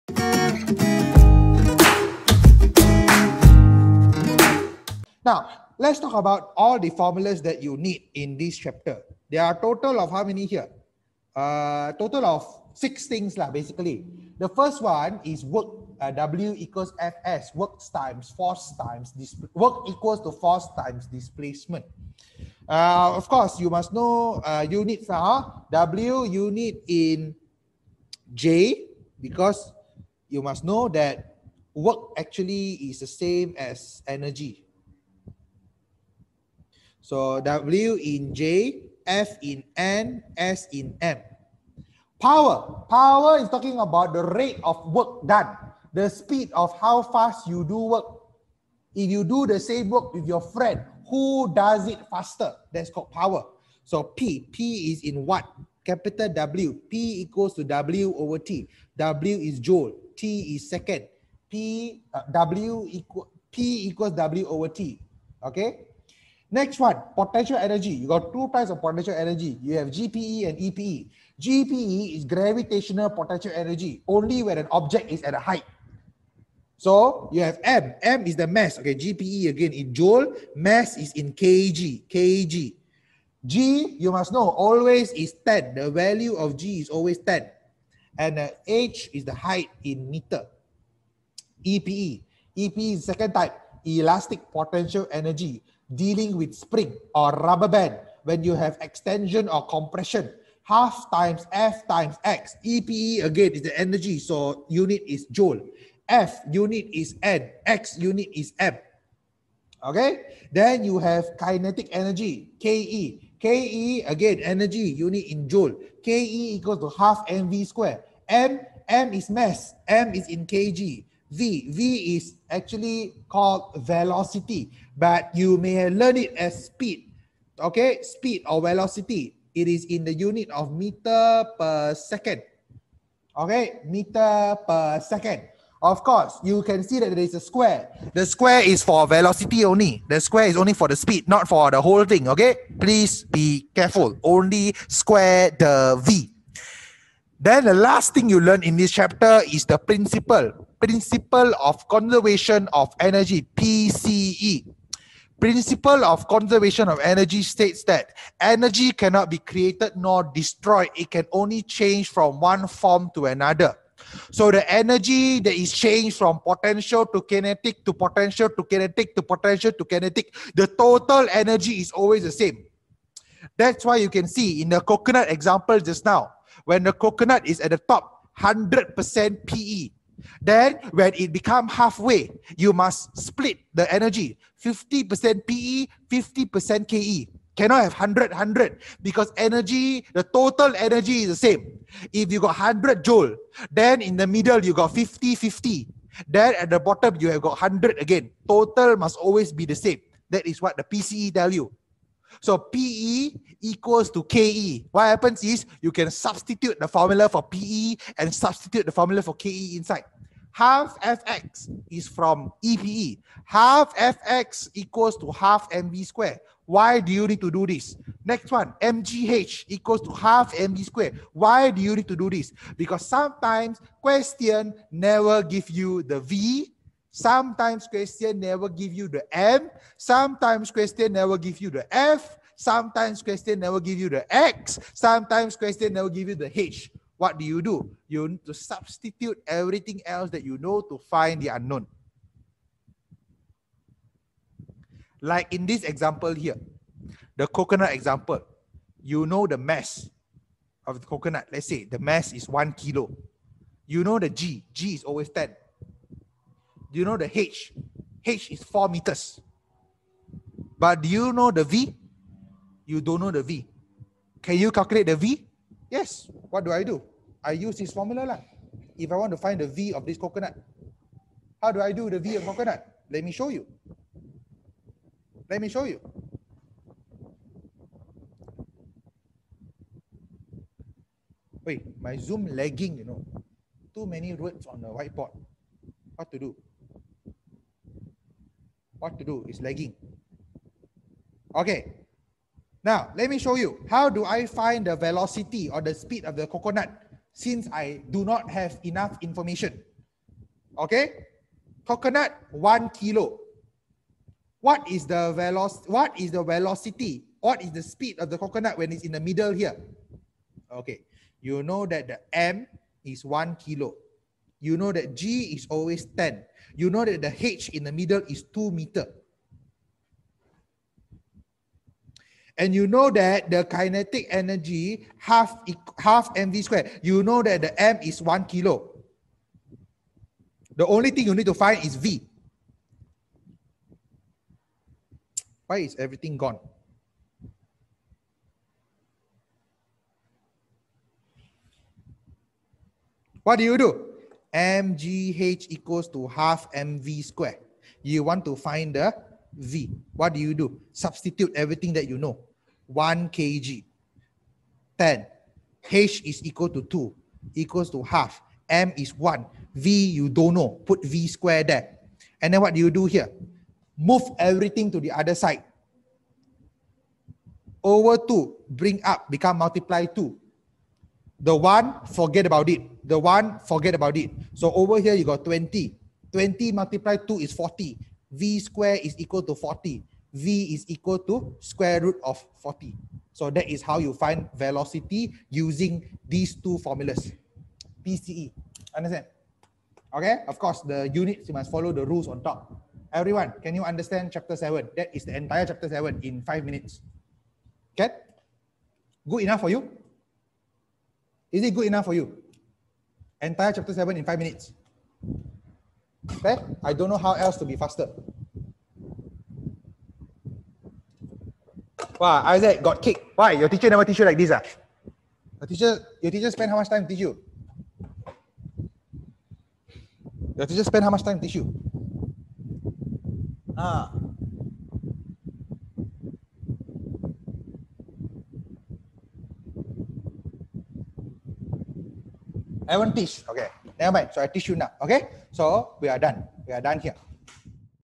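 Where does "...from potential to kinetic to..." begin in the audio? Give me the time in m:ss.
2:46.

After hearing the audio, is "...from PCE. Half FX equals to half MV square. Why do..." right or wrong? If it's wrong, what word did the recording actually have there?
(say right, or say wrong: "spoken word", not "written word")
wrong: "EPE", not "PCE".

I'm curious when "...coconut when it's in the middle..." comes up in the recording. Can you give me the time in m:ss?
5:08.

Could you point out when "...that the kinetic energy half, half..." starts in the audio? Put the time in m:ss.
5:23.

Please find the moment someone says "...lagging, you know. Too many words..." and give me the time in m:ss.
4:42.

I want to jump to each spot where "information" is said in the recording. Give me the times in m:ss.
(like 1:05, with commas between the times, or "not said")
4:59.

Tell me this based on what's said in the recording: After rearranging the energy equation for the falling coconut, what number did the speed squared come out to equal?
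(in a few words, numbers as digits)
40.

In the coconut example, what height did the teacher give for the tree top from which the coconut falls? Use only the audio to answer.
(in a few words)
4 meters.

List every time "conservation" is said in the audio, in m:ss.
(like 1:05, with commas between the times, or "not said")
2:31, 2:36.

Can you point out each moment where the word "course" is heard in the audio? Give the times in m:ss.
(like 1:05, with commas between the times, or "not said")
0:23, 2:16, 6:30.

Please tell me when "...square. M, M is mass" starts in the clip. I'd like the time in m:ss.
1:57.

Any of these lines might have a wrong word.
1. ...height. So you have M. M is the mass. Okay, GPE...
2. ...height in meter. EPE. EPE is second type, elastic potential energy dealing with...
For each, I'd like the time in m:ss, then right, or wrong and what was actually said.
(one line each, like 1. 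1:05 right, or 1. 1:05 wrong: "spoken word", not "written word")
1. 1:15 right
2. 1:29 right.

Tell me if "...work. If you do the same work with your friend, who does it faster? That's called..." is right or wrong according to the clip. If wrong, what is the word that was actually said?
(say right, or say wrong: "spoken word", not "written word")
right.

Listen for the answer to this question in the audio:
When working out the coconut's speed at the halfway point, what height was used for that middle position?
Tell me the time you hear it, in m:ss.
5:17.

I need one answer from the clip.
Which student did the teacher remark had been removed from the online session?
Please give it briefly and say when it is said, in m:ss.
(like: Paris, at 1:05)
Isaac, at 6:52.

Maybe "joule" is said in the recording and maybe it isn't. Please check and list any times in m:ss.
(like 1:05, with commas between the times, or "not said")
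0:59, 1:19, 1:45, 1:55, 3:13.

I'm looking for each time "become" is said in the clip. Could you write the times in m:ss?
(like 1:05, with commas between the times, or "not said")
3:01, 6:09.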